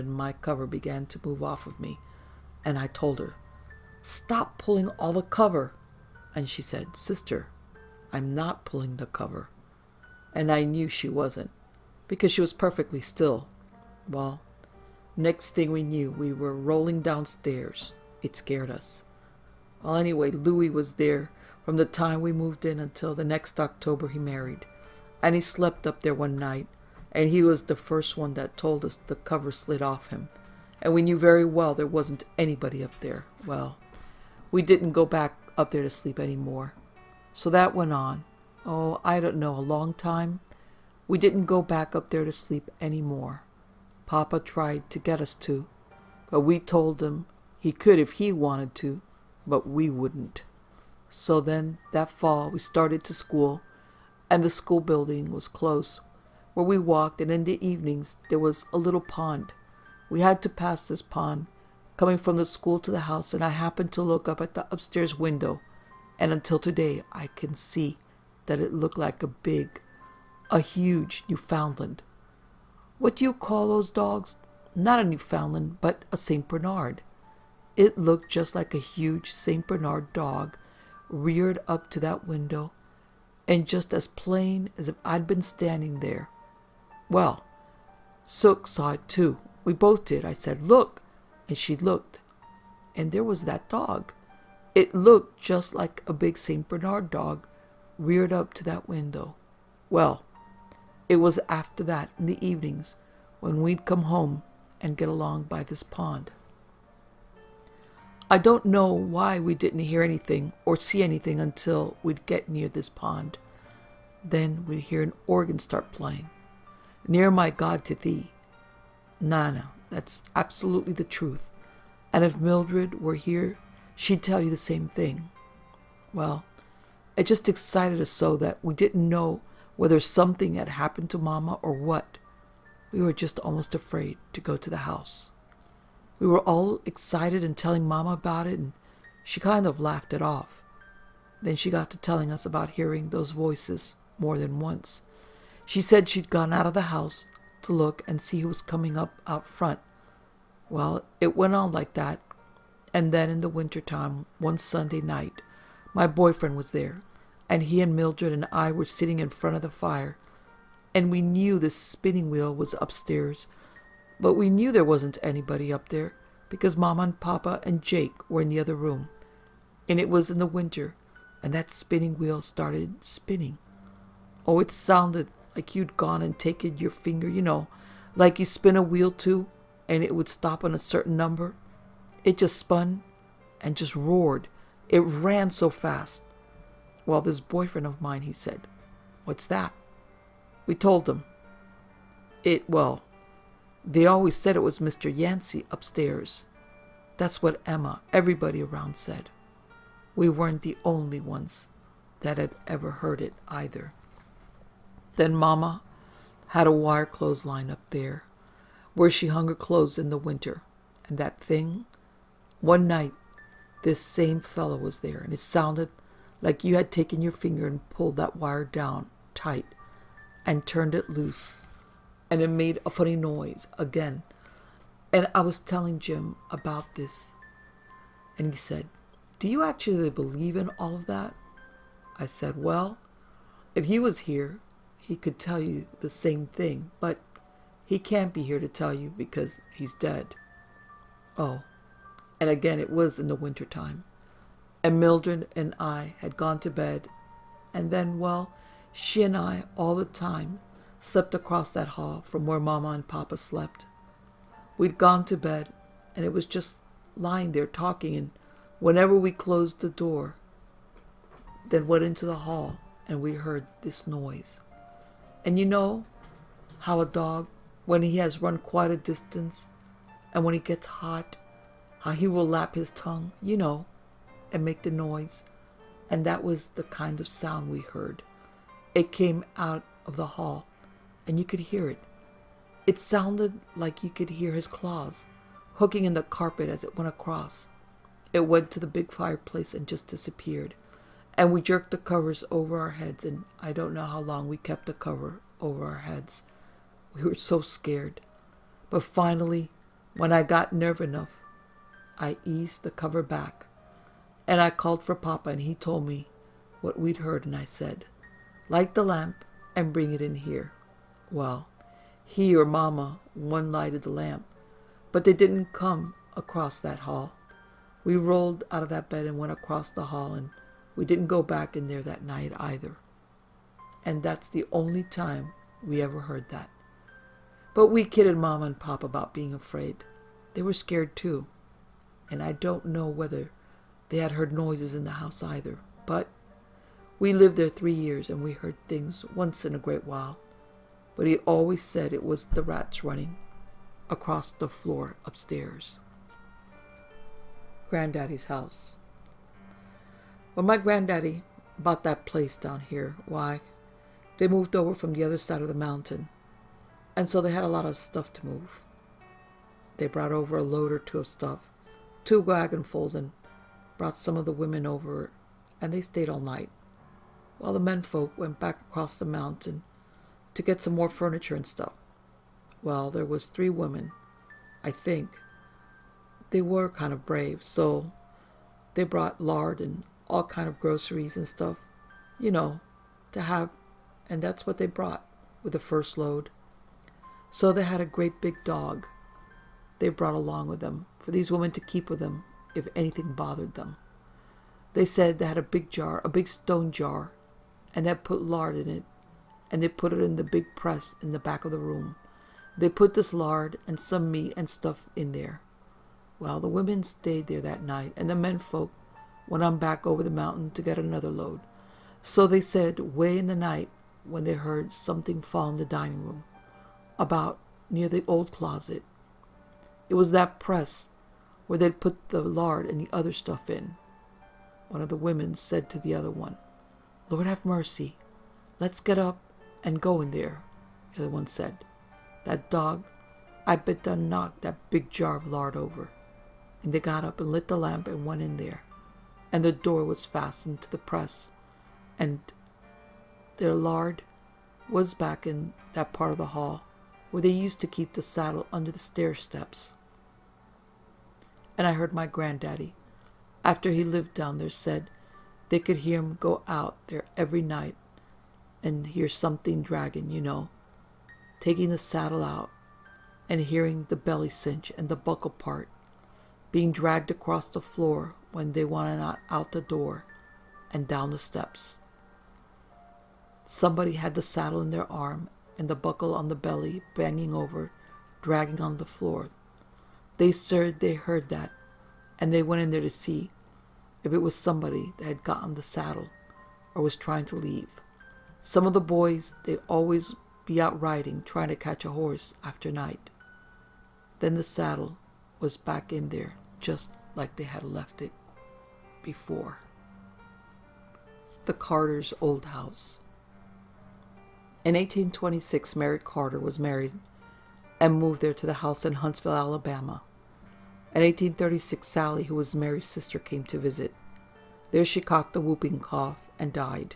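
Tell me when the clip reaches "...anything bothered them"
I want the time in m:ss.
6:32.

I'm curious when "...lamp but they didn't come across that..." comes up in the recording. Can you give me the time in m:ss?
5:14.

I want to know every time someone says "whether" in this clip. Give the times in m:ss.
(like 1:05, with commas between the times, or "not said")
2:09, 5:33.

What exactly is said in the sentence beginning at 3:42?
And it made a funny noise again.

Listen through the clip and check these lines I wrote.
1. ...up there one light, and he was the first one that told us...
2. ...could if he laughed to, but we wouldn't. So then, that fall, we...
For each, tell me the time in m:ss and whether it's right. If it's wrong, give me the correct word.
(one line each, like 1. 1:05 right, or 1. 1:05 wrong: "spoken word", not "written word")
1. 0:25 wrong: "night", not "light"
2. 0:47 wrong: "wanted", not "laughed".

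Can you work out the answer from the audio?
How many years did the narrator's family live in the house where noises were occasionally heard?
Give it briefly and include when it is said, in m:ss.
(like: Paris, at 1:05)
3, at 5:37.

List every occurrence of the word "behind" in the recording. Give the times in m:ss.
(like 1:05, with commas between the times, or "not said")
not said.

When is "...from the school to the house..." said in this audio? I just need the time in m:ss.
1:02.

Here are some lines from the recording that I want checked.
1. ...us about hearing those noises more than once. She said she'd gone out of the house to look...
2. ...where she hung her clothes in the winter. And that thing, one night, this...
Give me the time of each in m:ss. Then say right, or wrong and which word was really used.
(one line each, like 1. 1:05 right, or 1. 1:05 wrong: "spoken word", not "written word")
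1. 2:22 wrong: "voices", not "noises"
2. 3:28 right.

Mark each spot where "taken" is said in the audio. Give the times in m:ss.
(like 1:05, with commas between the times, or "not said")
2:56, 3:36.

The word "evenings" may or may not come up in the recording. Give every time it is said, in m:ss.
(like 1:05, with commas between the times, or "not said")
0:57, 1:42.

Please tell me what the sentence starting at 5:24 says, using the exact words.
And that's the only time we ever heard that.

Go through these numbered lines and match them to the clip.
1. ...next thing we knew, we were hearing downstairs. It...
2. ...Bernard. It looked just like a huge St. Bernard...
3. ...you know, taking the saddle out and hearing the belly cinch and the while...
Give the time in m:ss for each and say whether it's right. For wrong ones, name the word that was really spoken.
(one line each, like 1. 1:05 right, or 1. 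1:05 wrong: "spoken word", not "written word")
1. 0:15 wrong: "rolling", not "hearing"
2. 1:16 right
3. 7:40 wrong: "buckle", not "while".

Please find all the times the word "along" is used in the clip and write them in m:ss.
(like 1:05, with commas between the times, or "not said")
1:45, 6:30.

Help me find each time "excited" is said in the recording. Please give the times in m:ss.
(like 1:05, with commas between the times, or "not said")
2:07, 2:16.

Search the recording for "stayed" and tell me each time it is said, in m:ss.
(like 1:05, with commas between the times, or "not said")
6:05, 6:47.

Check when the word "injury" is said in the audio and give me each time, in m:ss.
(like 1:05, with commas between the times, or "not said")
not said.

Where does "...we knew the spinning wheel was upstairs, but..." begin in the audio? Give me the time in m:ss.
2:41.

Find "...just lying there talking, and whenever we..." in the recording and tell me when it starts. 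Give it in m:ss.
4:16.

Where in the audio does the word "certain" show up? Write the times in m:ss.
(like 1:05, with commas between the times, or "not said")
3:00.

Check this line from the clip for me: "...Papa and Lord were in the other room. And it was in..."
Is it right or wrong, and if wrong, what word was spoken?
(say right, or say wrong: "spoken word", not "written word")
wrong: "Jake", not "Lord".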